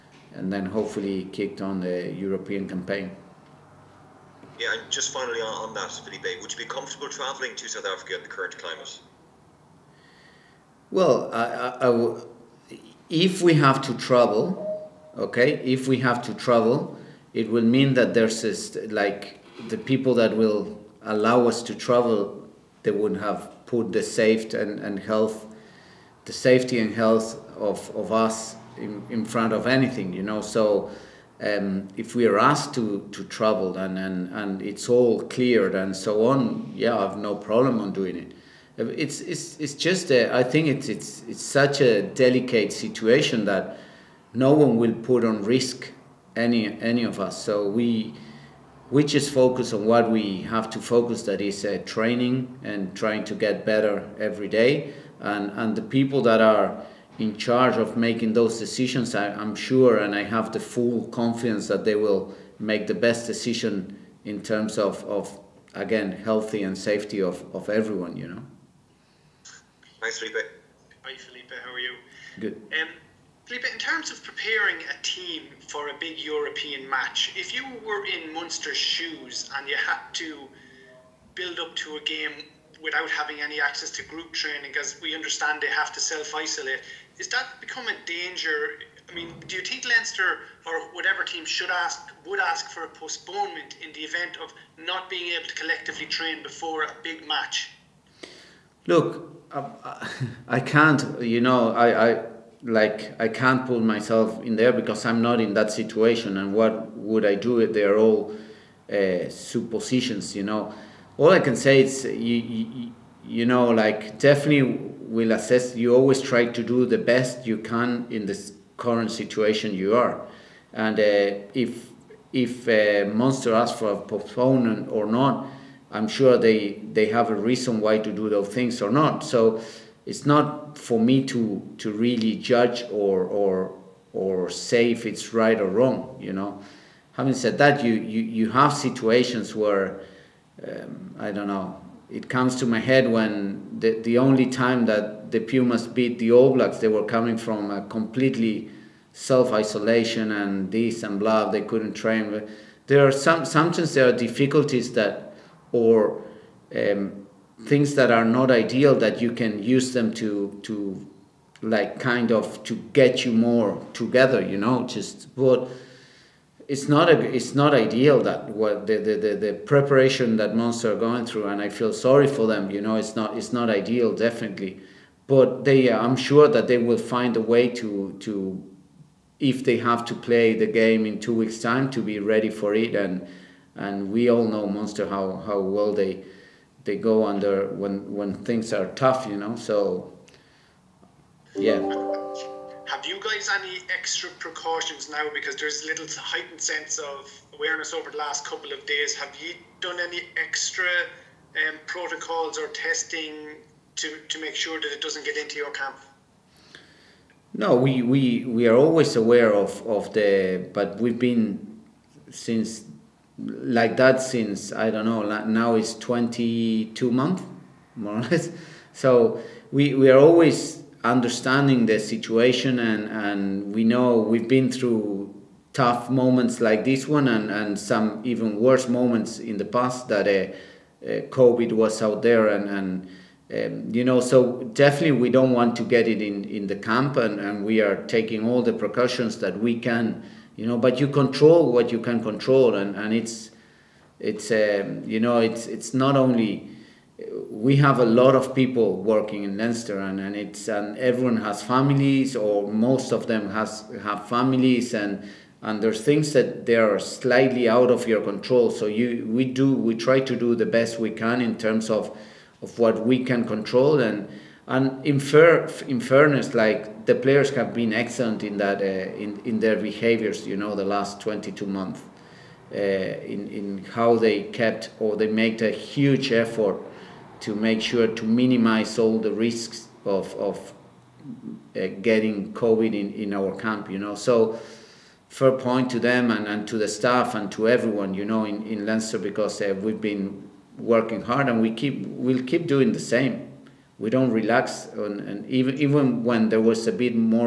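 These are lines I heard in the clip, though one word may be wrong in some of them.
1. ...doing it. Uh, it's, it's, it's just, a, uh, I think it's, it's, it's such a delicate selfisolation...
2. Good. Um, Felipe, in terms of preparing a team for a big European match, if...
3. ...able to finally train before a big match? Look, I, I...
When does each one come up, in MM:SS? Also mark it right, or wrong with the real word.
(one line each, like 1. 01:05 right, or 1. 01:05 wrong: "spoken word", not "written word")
1. 00:37 wrong: "situation", not "selfisolation"
2. 01:12 right
3. 01:35 wrong: "collectively", not "finally".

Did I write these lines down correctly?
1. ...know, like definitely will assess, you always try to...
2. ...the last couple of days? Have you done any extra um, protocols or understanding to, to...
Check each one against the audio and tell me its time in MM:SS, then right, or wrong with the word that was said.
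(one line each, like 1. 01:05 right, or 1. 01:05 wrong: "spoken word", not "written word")
1. 01:53 right
2. 03:18 wrong: "testing", not "understanding".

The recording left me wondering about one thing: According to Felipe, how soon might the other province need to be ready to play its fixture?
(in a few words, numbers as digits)
2 weeks.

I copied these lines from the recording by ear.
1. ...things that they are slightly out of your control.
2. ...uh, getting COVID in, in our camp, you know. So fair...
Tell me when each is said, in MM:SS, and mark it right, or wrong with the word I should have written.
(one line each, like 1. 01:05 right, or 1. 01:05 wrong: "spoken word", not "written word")
1. 04:16 right
2. 04:41 right.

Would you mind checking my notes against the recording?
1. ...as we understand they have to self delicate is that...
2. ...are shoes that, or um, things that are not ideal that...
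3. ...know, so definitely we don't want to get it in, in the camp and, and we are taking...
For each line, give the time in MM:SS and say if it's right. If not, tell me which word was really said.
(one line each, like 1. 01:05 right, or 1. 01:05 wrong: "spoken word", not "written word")
1. 01:24 wrong: "isolate", not "delicate"
2. 02:34 wrong: "difficulties", not "shoes"
3. 03:54 right.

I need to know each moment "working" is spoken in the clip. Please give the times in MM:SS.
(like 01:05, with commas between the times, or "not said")
04:08, 04:50.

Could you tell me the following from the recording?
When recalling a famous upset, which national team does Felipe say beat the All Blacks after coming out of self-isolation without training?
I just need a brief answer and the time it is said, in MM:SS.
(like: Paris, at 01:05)
the Pumas, at 02:25.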